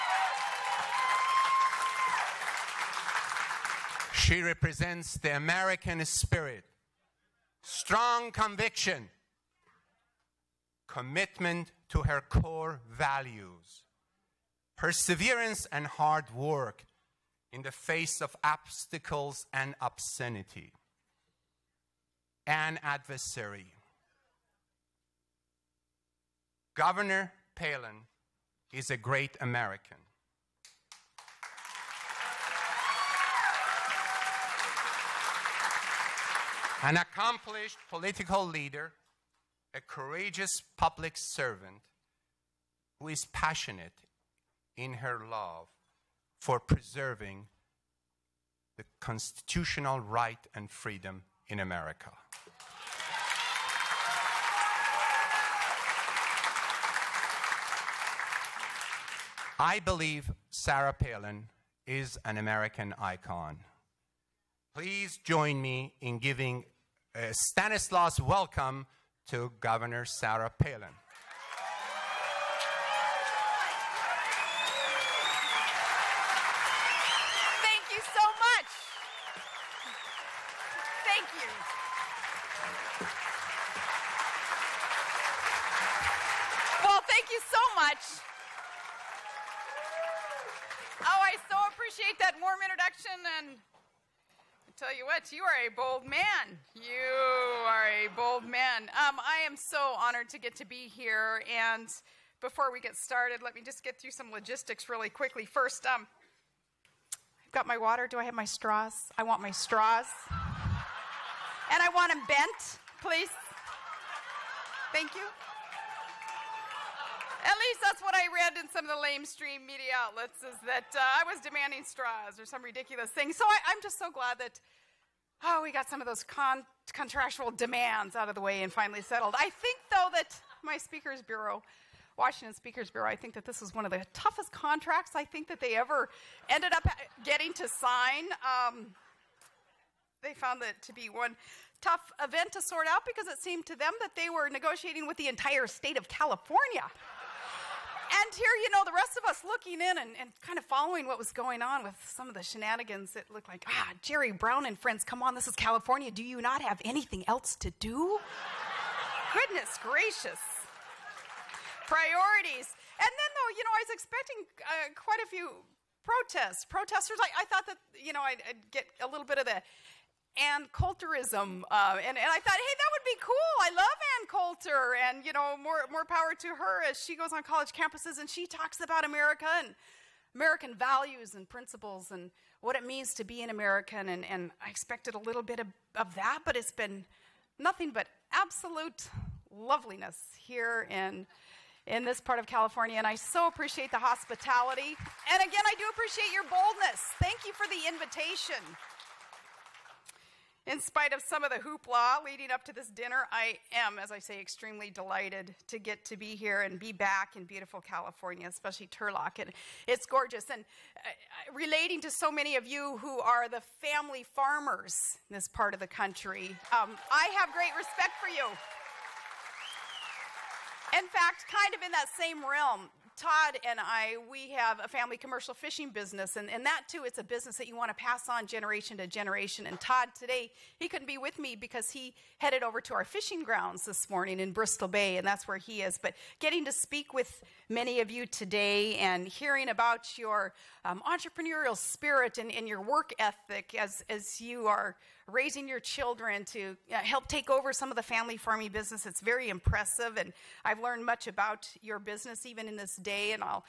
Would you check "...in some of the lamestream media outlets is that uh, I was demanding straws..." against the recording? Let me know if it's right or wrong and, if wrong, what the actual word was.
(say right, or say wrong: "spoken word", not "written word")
right.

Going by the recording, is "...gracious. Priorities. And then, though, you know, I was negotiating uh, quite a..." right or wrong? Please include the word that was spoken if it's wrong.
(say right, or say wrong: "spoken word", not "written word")
wrong: "expecting", not "negotiating".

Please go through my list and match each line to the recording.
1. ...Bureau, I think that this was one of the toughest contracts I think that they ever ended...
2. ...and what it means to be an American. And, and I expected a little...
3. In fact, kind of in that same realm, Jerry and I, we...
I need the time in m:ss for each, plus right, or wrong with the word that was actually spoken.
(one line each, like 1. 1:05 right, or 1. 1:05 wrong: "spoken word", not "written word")
1. 2:12 right
2. 3:02 right
3. 3:40 wrong: "Todd", not "Jerry".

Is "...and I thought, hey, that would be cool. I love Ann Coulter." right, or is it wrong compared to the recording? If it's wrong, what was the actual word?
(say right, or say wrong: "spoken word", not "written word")
right.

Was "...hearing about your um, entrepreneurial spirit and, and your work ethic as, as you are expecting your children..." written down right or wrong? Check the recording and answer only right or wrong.
wrong.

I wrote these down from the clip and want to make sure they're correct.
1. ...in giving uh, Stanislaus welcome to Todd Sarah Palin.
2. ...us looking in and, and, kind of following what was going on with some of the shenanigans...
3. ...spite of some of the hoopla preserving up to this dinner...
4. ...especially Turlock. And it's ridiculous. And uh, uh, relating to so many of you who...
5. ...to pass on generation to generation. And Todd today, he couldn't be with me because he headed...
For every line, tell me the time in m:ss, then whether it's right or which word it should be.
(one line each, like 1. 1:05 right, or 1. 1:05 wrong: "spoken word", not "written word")
1. 1:06 wrong: "Governor", not "Todd"
2. 2:29 right
3. 3:20 wrong: "leading", not "preserving"
4. 3:28 wrong: "gorgeous", not "ridiculous"
5. 3:47 right.